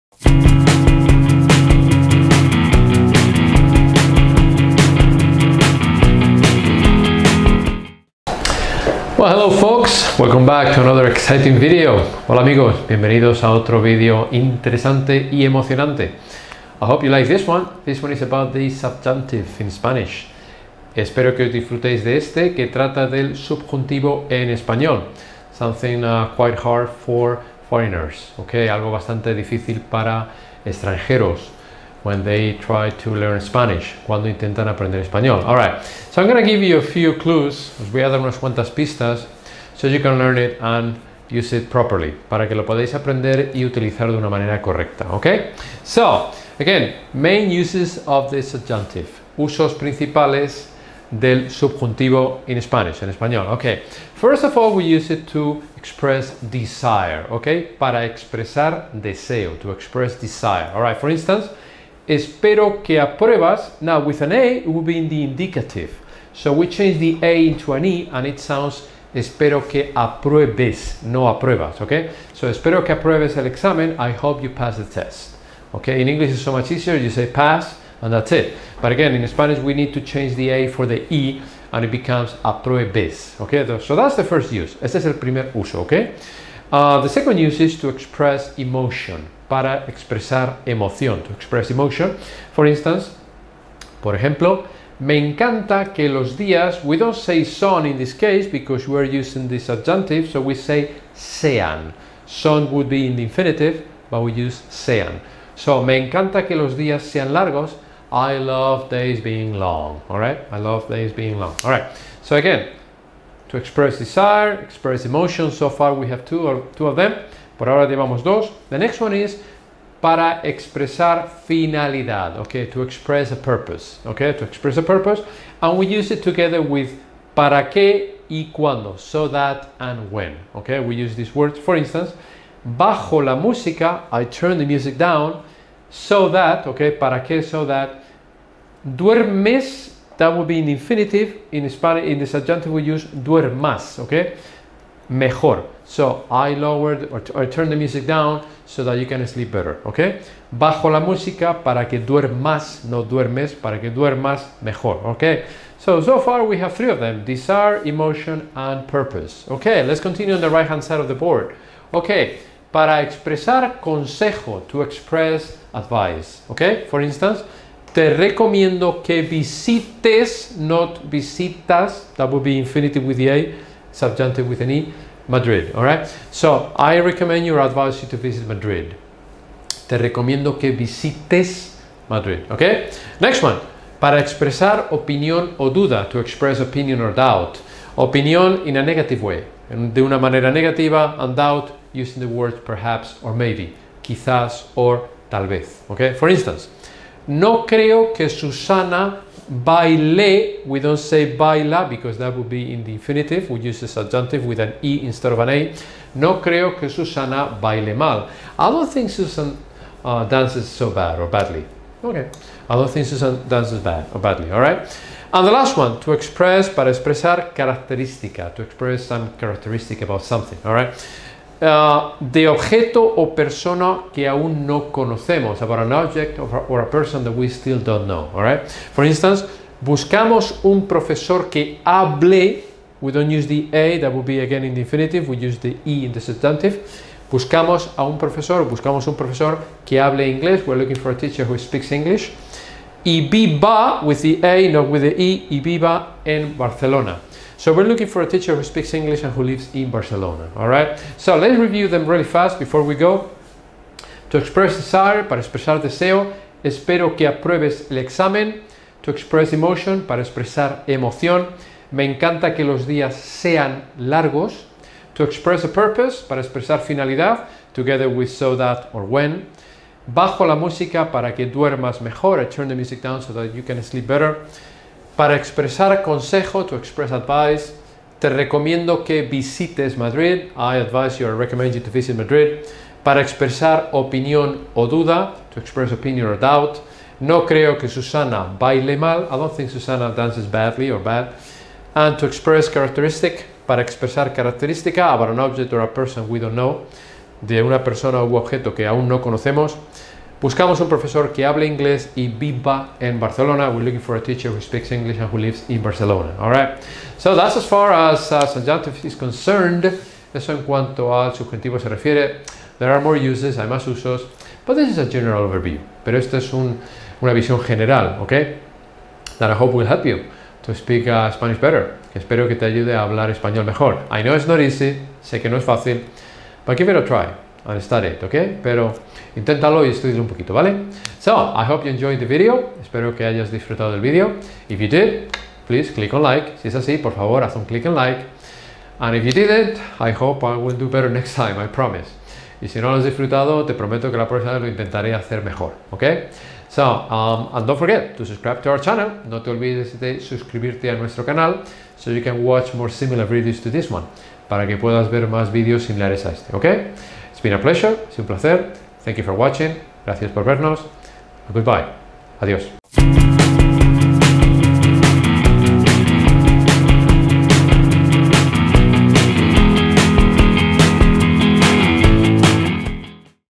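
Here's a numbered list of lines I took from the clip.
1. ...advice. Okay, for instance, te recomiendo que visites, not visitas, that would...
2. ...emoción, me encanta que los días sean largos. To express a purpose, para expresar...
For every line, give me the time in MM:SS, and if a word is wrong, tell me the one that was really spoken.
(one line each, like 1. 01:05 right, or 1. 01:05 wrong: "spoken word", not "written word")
1. 02:45 right
2. 04:20 right.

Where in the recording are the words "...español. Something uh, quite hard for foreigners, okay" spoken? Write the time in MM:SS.
00:24.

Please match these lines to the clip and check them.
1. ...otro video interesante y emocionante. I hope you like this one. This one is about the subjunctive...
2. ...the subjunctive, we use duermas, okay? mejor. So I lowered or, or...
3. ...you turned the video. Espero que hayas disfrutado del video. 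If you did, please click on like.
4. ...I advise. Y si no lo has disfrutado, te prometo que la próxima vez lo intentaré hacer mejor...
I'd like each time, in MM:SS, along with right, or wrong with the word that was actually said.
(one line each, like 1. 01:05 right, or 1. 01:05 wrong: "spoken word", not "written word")
1. 00:13 right
2. 02:22 right
3. 05:31 wrong: "enjoyed", not "turned"
4. 05:41 wrong: "promise", not "advise".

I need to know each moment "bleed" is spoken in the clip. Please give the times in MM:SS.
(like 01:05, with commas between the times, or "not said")
not said.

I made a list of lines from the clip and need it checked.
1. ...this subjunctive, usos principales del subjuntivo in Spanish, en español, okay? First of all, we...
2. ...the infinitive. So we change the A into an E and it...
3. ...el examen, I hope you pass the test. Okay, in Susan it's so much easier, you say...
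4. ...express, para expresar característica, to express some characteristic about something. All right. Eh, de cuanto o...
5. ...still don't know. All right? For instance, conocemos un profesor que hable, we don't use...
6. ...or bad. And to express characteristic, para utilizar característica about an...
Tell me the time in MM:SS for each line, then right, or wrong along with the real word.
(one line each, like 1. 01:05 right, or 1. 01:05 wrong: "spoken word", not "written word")
1. 00:48 right
2. 01:05 wrong: "indicative", not "infinitive"
3. 01:13 wrong: "English", not "Susan"
4. 03:36 wrong: "objeto", not "cuanto"
5. 03:47 wrong: "buscamos", not "conocemos"
6. 04:50 wrong: "expresar", not "utilizar".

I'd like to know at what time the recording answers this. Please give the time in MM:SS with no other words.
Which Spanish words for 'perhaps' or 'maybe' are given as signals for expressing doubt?
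03:14.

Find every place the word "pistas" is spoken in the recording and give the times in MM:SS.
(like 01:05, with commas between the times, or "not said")
00:38.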